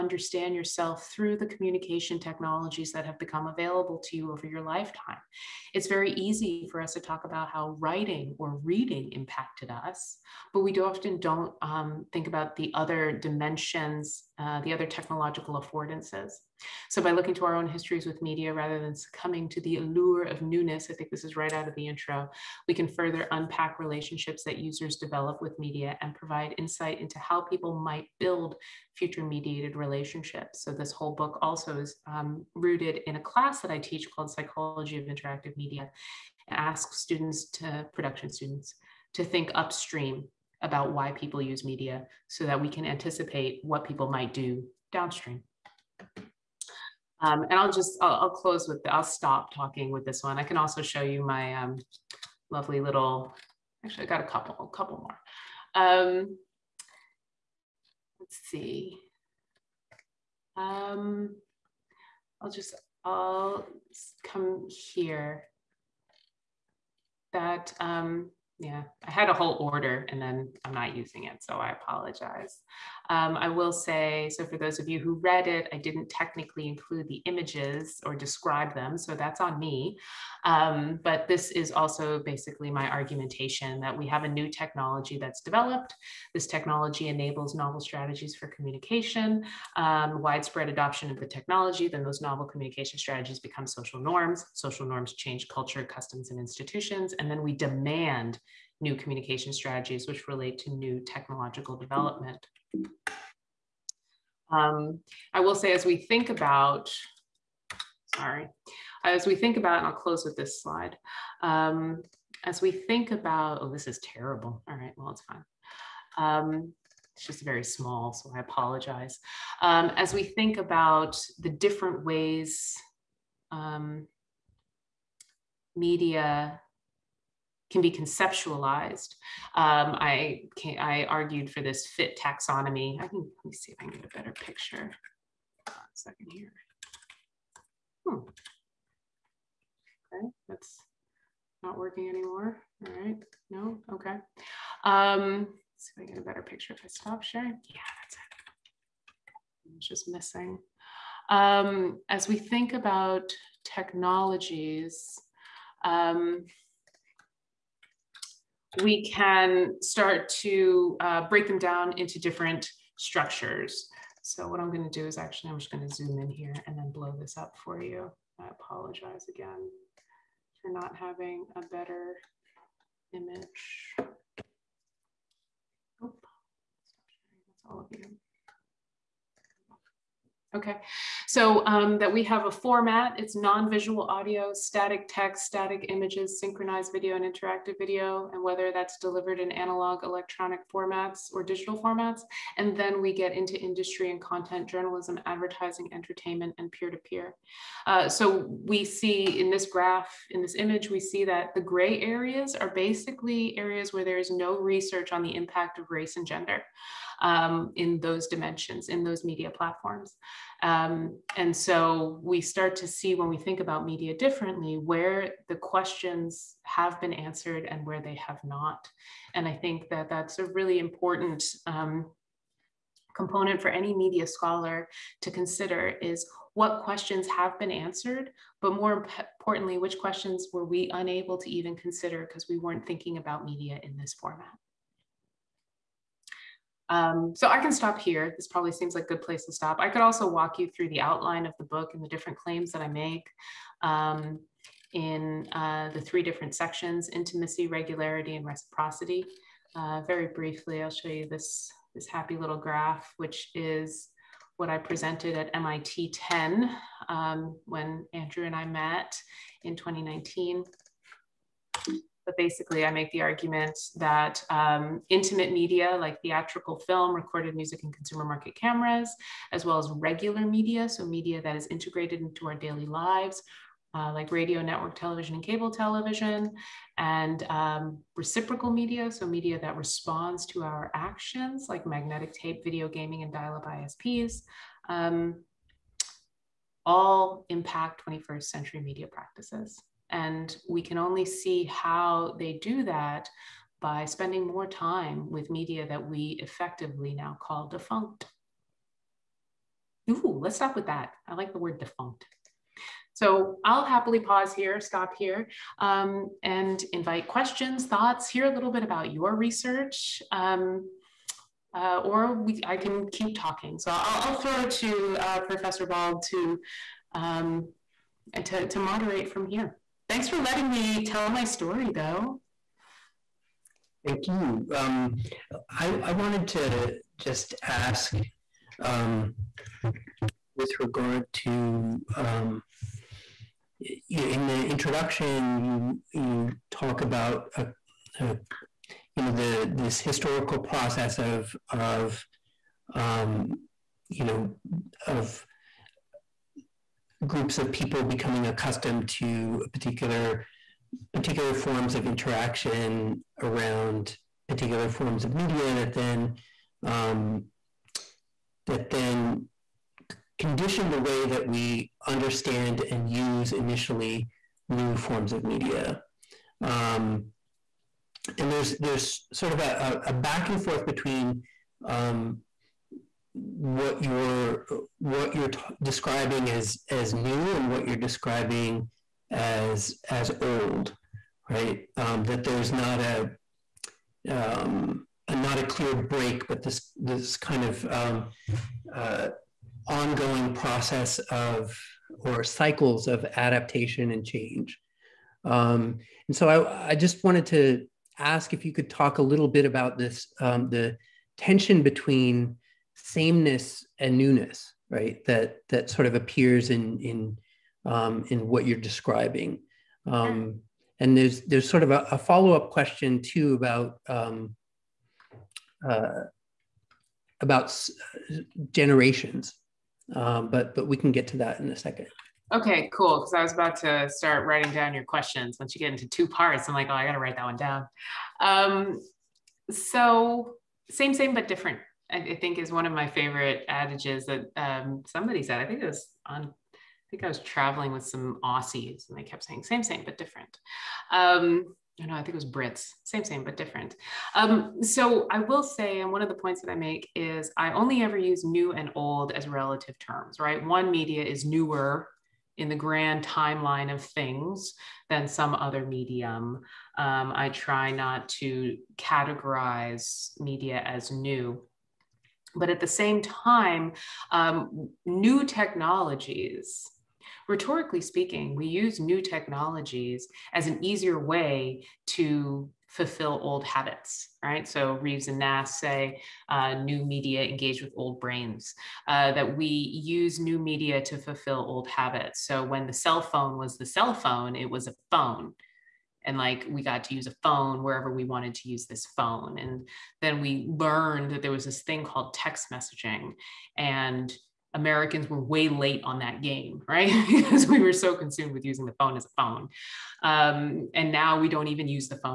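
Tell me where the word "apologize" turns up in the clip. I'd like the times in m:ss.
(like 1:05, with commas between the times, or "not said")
1:11, 1:58, 2:48.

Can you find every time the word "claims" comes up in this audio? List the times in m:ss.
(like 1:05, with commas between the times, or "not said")
4:02.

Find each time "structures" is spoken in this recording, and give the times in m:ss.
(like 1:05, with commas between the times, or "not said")
2:42.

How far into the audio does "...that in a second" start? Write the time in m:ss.
7:01.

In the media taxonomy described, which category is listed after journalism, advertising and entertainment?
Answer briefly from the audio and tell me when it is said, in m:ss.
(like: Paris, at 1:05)
peer-to-peer, at 3:16.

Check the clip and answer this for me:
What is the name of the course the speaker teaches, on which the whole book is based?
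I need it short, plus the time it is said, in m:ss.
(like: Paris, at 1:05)
Psychology of Interactive Media, at 0:34.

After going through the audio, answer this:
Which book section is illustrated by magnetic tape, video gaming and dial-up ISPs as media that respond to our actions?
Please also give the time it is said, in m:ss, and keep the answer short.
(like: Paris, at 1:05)
reciprocity, at 4:08.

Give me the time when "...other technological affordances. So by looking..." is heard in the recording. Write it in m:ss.
0:14.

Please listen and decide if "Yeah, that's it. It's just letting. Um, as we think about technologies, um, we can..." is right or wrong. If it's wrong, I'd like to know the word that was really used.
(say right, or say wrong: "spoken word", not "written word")
wrong: "missing", not "letting".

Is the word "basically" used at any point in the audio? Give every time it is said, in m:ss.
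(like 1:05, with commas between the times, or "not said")
1:22, 3:22, 4:22.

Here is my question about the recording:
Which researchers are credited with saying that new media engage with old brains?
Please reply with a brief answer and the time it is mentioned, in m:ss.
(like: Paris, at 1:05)
Reeves and Nass, at 7:54.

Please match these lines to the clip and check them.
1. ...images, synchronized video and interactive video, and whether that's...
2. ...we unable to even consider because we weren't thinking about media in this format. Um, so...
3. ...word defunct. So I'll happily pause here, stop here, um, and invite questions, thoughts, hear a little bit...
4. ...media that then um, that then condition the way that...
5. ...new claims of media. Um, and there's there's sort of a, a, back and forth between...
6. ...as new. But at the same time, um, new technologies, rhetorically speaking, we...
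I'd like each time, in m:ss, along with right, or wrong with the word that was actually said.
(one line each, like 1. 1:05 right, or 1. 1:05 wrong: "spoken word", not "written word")
1. 3:05 right
2. 3:50 right
3. 5:01 right
4. 5:55 right
5. 6:04 wrong: "forms", not "claims"
6. 7:40 right.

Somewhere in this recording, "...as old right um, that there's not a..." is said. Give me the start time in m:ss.
6:20.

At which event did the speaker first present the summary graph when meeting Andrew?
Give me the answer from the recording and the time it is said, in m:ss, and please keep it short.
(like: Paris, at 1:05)
MIT 10, at 4:15.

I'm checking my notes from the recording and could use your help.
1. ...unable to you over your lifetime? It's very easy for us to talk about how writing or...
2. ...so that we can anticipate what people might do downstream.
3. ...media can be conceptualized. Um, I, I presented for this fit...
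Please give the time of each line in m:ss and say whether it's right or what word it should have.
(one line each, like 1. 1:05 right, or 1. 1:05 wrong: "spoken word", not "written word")
1. 0:03 wrong: "available", not "unable"
2. 0:42 right
3. 2:05 wrong: "argued", not "presented".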